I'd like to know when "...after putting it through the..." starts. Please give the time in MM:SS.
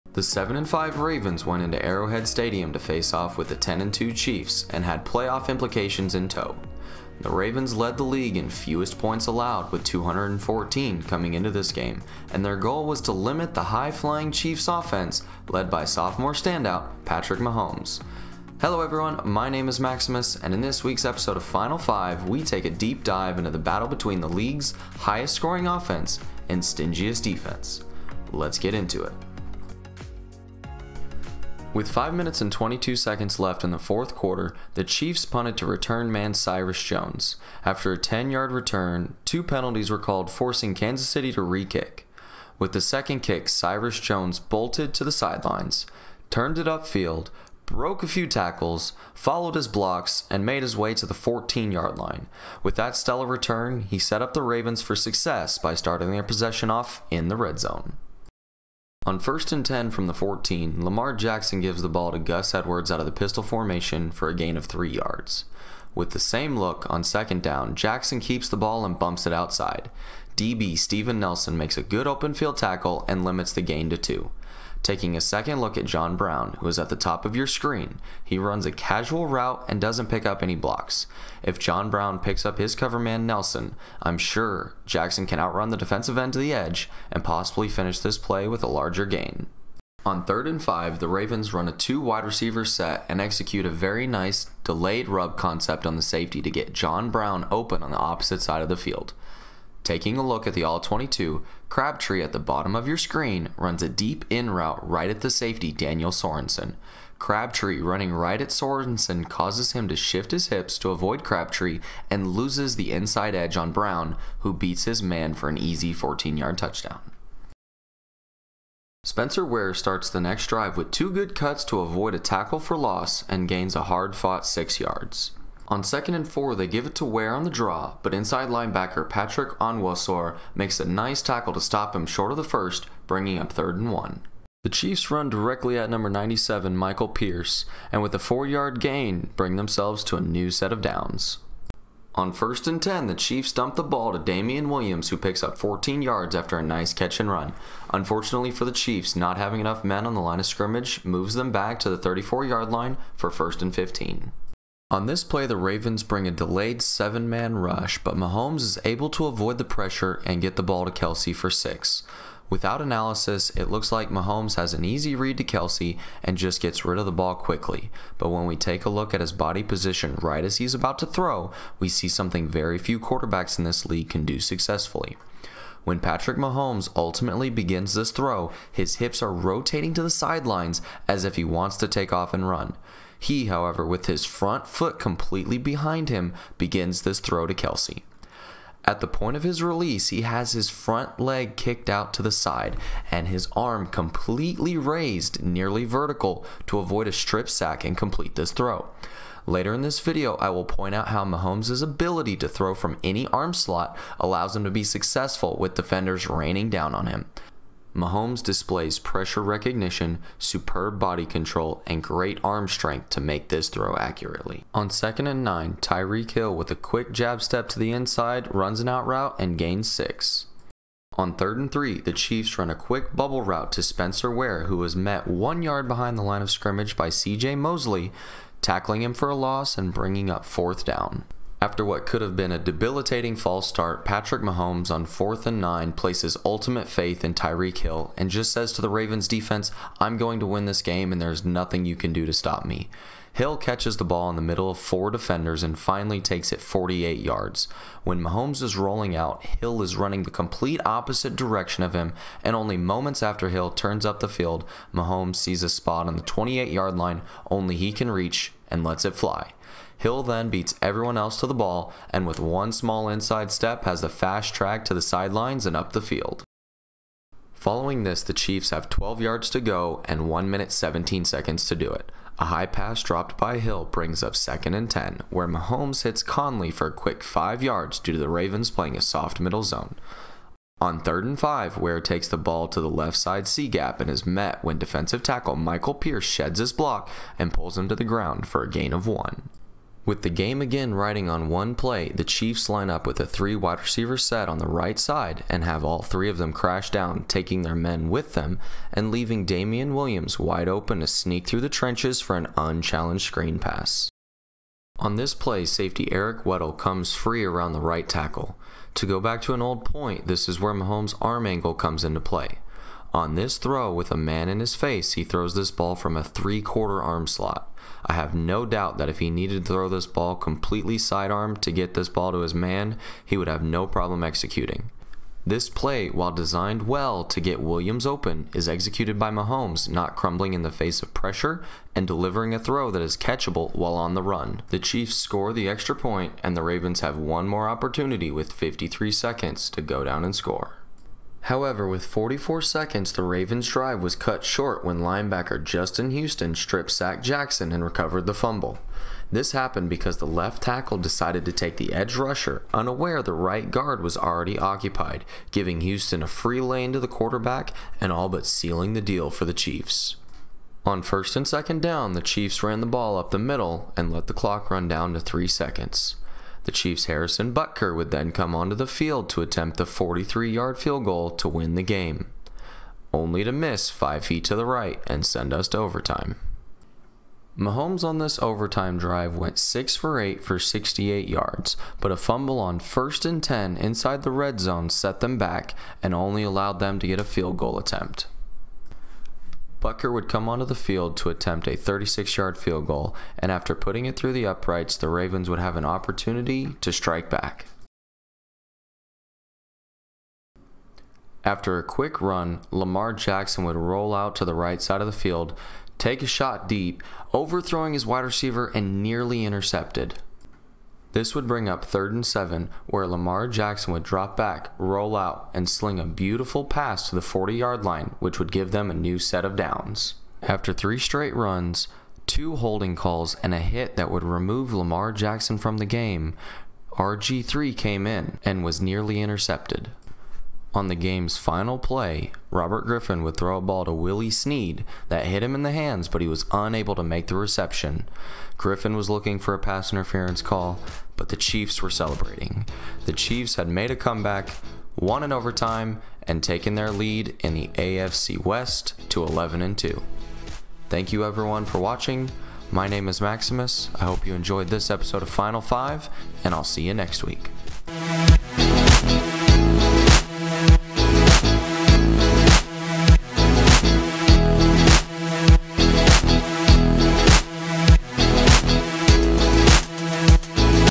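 06:33.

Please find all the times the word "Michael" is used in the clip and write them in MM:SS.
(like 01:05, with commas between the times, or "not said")
02:16, 04:45.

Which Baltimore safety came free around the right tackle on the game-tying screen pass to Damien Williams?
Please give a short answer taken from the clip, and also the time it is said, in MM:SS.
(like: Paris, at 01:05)
Eric Weddle, at 05:06.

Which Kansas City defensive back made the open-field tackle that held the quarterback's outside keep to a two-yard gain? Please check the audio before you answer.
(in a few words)
Steven Nelson.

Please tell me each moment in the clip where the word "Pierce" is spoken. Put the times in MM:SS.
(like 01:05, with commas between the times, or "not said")
02:17, 04:45.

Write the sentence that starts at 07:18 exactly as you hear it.
Griffin was looking for a pass interference call, but the Chiefs were celebrating.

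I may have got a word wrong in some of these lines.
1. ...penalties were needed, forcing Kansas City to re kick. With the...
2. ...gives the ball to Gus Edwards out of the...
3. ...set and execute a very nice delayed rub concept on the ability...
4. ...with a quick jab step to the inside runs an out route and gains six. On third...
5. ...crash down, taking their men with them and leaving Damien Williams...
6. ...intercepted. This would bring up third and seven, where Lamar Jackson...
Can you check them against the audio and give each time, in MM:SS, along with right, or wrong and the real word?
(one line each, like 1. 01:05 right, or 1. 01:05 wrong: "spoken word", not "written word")
1. 00:39 wrong: "called", not "needed"
2. 01:01 right
3. 01:32 wrong: "safety", not "ability"
4. 03:36 right
5. 04:56 right
6. 06:49 right.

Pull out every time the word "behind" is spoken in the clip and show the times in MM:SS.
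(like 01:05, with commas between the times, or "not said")
03:05, 03:45.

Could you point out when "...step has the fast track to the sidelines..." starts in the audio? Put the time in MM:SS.
04:23.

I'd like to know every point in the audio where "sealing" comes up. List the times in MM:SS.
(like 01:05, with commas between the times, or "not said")
05:58.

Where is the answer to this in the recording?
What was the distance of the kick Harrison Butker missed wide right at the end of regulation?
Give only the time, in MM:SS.
06:09.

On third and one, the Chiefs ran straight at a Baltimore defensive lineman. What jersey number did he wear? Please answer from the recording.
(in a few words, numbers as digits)
97.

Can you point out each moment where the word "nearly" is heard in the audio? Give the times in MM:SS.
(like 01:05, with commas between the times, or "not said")
03:15, 06:49, 07:08.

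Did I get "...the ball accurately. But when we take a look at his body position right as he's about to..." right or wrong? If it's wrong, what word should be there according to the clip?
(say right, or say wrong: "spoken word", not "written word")
wrong: "quickly", not "accurately".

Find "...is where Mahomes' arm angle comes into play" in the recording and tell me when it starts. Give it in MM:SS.
05:10.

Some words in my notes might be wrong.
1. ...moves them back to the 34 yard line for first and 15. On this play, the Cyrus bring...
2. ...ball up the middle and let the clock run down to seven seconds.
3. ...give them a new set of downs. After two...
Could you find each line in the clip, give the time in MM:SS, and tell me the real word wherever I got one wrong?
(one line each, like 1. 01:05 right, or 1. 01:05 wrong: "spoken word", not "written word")
1. 02:31 wrong: "Ravens", not "Cyrus"
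2. 06:02 wrong: "three", not "seven"
3. 06:58 wrong: "three", not "two".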